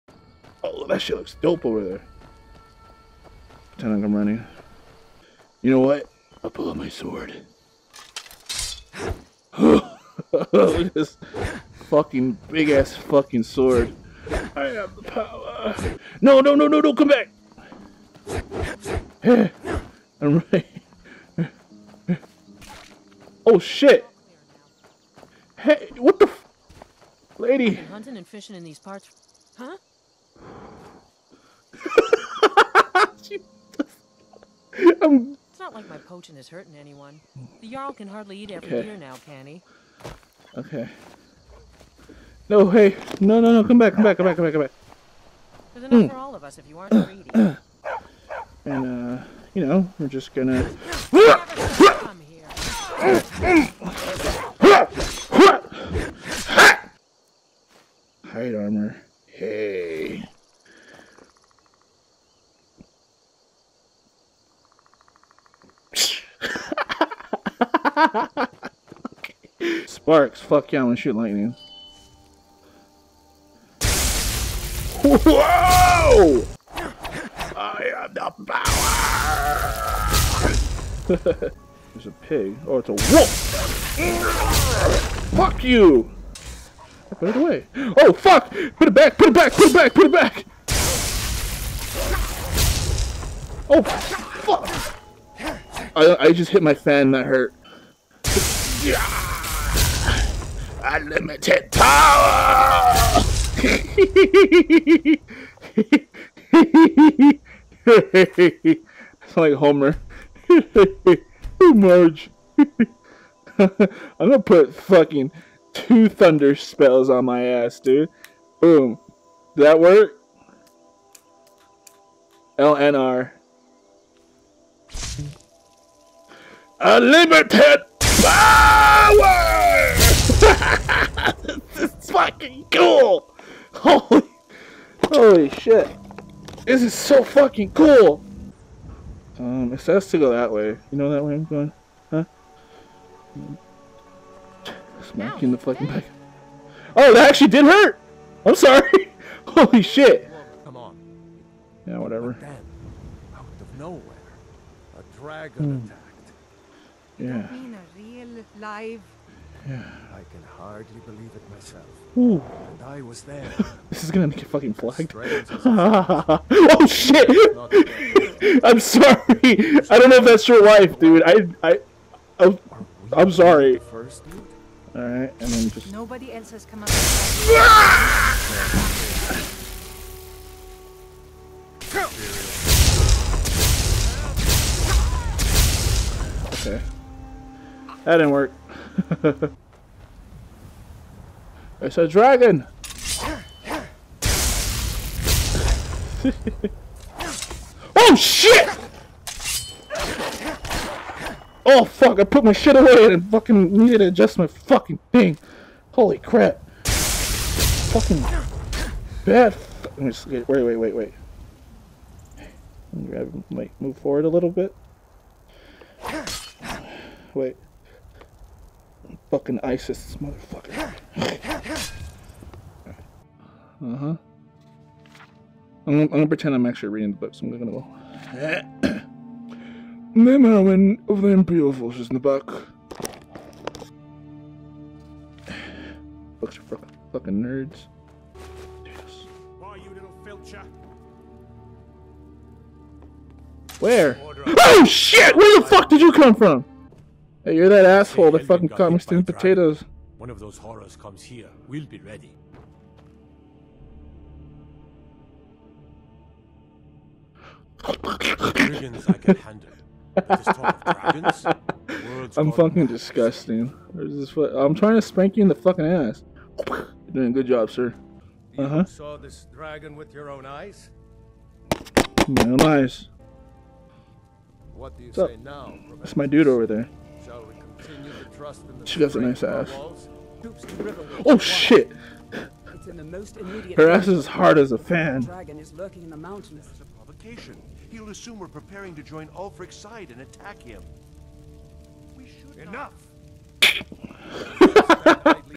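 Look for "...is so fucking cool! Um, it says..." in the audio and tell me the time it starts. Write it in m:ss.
2:16.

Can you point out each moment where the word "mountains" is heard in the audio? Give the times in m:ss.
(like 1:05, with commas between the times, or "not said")
4:46.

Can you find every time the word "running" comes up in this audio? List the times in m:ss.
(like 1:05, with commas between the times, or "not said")
0:04.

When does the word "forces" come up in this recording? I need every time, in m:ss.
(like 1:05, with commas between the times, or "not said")
3:51.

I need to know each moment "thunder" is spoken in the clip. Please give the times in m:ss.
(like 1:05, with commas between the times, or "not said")
1:56.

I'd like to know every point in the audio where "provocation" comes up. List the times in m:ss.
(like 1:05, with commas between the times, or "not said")
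4:46.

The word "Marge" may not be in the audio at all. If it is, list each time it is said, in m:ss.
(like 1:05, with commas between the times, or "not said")
1:51.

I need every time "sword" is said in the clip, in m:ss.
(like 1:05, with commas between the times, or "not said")
0:06, 0:13.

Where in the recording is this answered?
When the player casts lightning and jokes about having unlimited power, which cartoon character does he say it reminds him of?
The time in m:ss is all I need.
1:49.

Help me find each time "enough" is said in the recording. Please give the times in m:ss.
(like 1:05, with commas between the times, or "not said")
0:45, 4:52.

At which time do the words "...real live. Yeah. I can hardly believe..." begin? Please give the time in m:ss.
2:38.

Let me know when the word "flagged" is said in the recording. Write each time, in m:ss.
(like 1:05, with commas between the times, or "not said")
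2:44.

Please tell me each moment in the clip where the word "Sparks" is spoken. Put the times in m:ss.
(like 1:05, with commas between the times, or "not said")
1:09.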